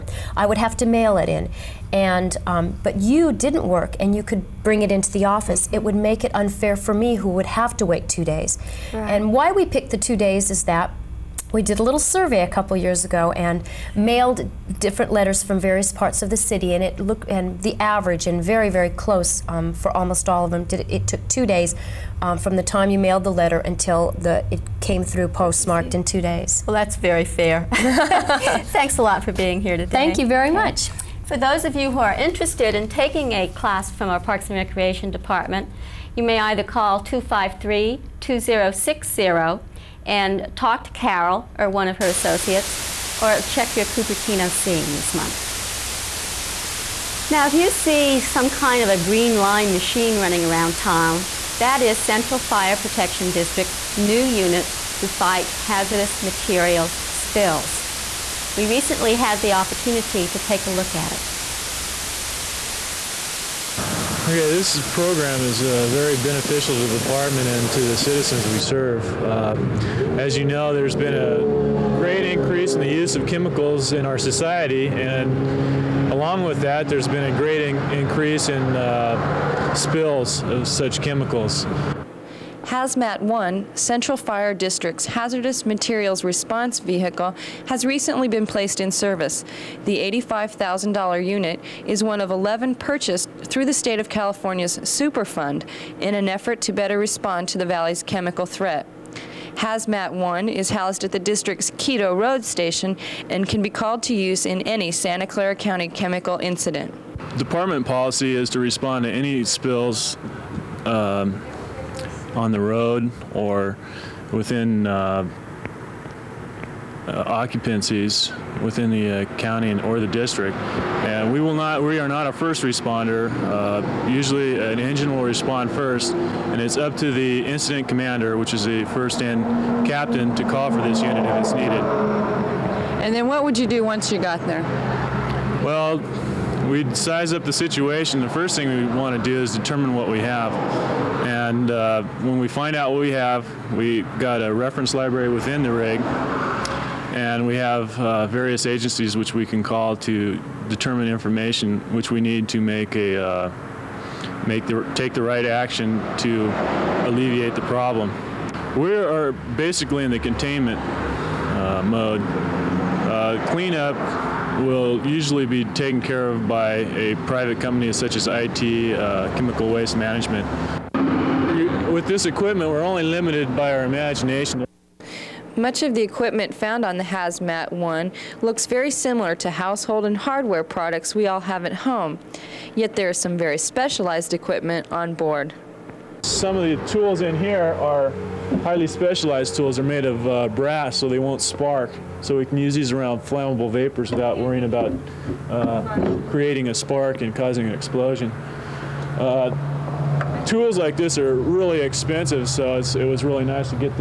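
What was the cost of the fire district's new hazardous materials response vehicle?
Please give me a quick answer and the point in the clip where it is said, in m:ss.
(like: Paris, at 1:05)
$85,000, at 1:29.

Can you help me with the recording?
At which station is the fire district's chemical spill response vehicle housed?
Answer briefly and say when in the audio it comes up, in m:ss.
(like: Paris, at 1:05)
Quito Road Station, at 1:41.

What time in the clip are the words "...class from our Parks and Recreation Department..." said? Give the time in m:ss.
0:33.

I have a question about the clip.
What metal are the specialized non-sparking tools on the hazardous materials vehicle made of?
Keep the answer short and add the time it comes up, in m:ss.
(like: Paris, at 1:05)
Brass, at 3:10.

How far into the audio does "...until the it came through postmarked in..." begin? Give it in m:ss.
0:23.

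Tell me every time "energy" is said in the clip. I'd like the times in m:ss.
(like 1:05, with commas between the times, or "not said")
not said.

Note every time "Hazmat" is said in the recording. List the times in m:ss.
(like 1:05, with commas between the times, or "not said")
1:22, 1:39, 2:57.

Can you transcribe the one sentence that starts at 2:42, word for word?
Uh, cleanup will usually be taken care of by a private company such as IT, uh, Chemical Waste Management.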